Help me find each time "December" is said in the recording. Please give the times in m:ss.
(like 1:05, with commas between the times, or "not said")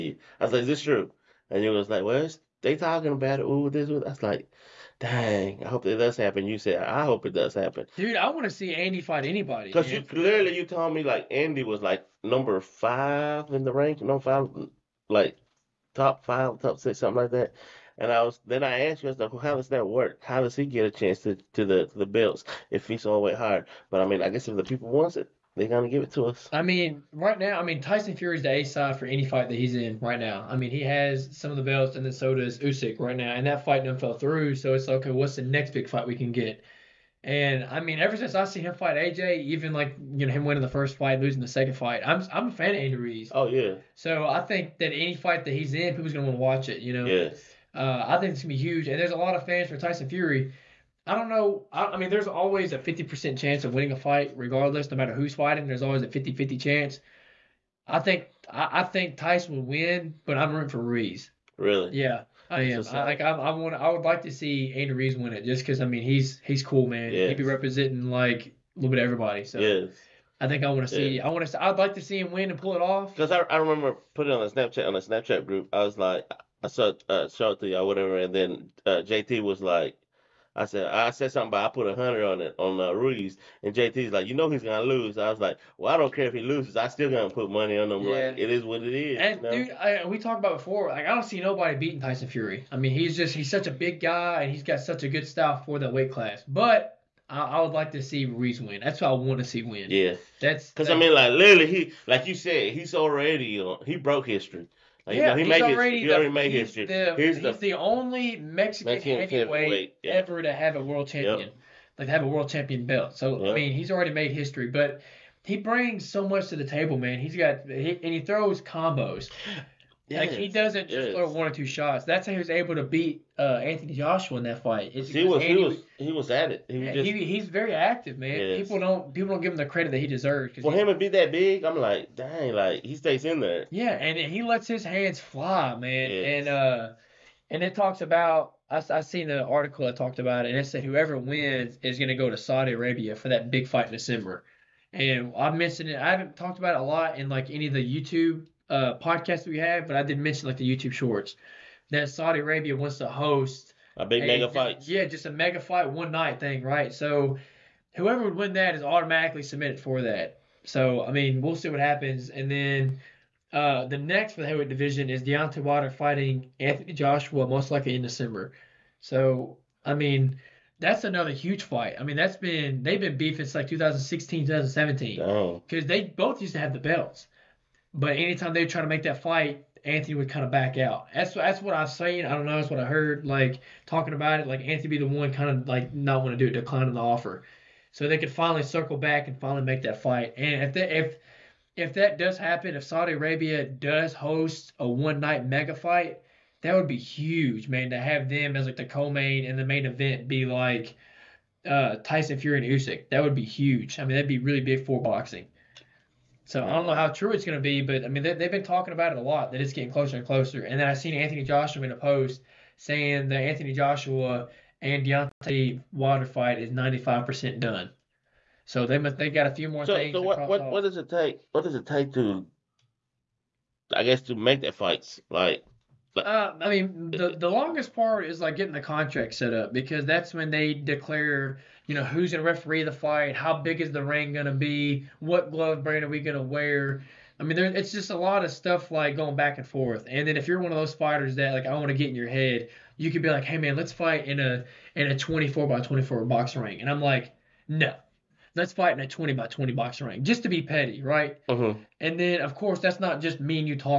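2:23, 2:48.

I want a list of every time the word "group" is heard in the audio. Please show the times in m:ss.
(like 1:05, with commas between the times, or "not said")
1:15.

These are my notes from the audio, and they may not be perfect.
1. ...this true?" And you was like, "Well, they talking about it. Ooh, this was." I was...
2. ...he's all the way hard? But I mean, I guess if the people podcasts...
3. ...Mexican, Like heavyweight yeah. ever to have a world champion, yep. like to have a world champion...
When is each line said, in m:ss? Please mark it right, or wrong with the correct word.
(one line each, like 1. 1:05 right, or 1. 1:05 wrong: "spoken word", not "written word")
1. 0:00 right
2. 0:22 wrong: "wants", not "podcasts"
3. 1:48 wrong: "Mexican", not "Like".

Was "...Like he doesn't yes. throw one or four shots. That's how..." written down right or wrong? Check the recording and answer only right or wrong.
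wrong.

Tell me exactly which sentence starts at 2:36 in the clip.
So whoever would win that is automatically submitted for that.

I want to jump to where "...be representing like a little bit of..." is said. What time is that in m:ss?
1:07.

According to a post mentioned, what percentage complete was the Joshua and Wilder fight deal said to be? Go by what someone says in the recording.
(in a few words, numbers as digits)
95%.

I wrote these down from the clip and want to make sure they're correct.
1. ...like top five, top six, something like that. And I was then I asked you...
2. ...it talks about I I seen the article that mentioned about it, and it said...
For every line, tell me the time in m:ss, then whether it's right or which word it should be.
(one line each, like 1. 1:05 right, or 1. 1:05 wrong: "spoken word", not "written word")
1. 0:15 right
2. 2:17 wrong: "talked", not "mentioned".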